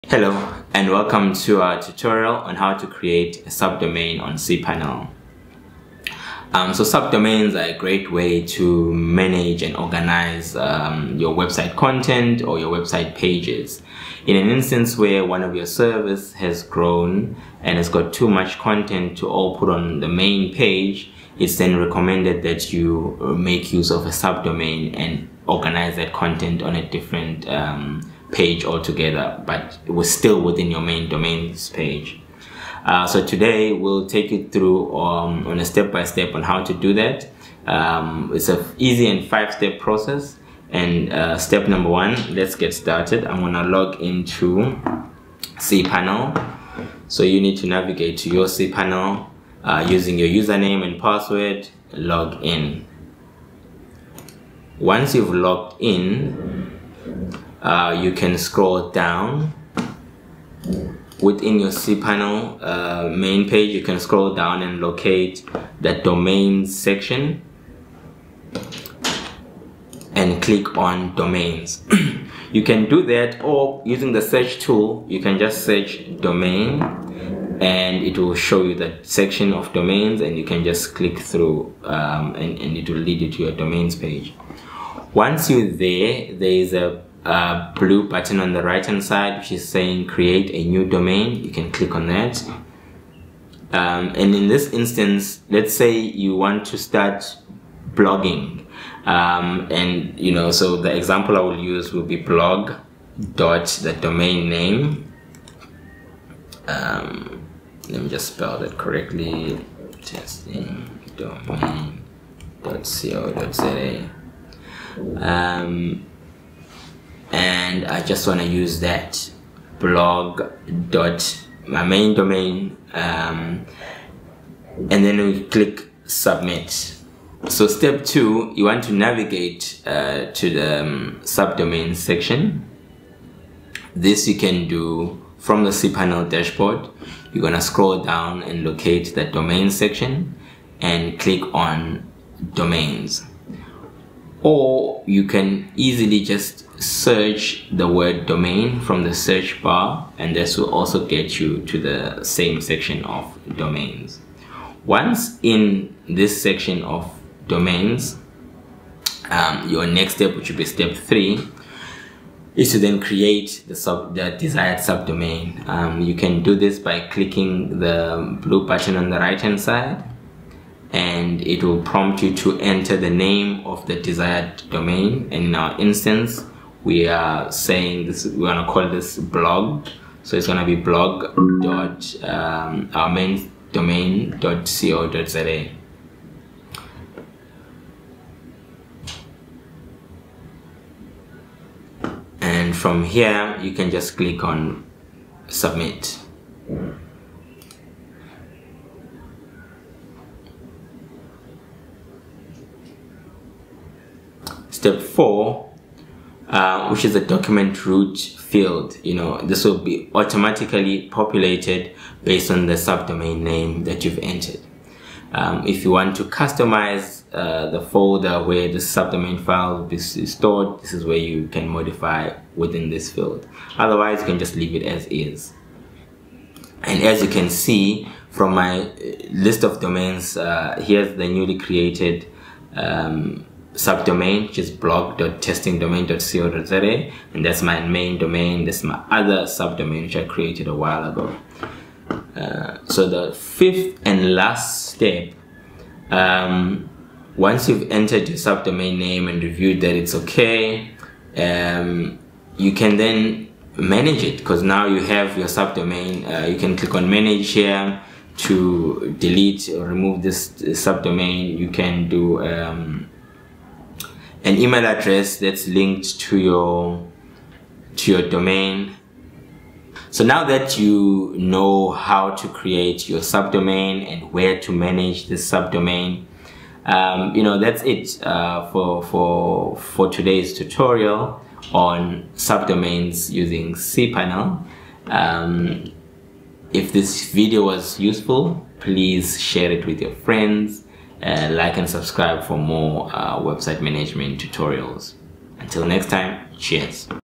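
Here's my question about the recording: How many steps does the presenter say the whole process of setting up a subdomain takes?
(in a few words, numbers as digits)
5.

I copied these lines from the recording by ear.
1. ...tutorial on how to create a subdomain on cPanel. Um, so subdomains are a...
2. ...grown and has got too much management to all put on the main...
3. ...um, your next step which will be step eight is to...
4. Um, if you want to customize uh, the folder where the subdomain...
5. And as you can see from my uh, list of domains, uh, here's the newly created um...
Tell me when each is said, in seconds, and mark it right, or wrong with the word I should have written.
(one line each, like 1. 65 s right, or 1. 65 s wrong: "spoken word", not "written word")
1. 1 s right
2. 16 s wrong: "content", not "management"
3. 159 s wrong: "three", not "eight"
4. 215 s right
5. 226 s right.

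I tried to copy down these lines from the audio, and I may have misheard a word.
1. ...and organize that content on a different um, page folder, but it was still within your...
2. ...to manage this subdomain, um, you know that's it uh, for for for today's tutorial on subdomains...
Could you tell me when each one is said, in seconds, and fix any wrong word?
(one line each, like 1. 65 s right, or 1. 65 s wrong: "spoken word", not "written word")
1. 24 s wrong: "altogether", not "folder"
2. 274 s right.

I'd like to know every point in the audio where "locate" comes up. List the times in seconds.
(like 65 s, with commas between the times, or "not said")
64 s, 138 s.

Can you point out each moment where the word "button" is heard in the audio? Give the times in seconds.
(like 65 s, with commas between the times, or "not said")
88 s, 168 s.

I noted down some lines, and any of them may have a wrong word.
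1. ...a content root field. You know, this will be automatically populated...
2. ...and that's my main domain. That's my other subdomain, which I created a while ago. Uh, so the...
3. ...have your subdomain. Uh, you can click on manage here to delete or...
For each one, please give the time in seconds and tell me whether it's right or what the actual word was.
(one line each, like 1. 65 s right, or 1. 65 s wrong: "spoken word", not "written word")
1. 207 s wrong: "document", not "content"
2. 237 s right
3. 255 s right.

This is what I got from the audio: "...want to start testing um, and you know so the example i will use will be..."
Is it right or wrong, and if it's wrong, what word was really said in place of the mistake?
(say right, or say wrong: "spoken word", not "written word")
wrong: "blogging", not "testing".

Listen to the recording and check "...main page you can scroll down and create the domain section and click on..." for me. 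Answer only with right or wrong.
wrong.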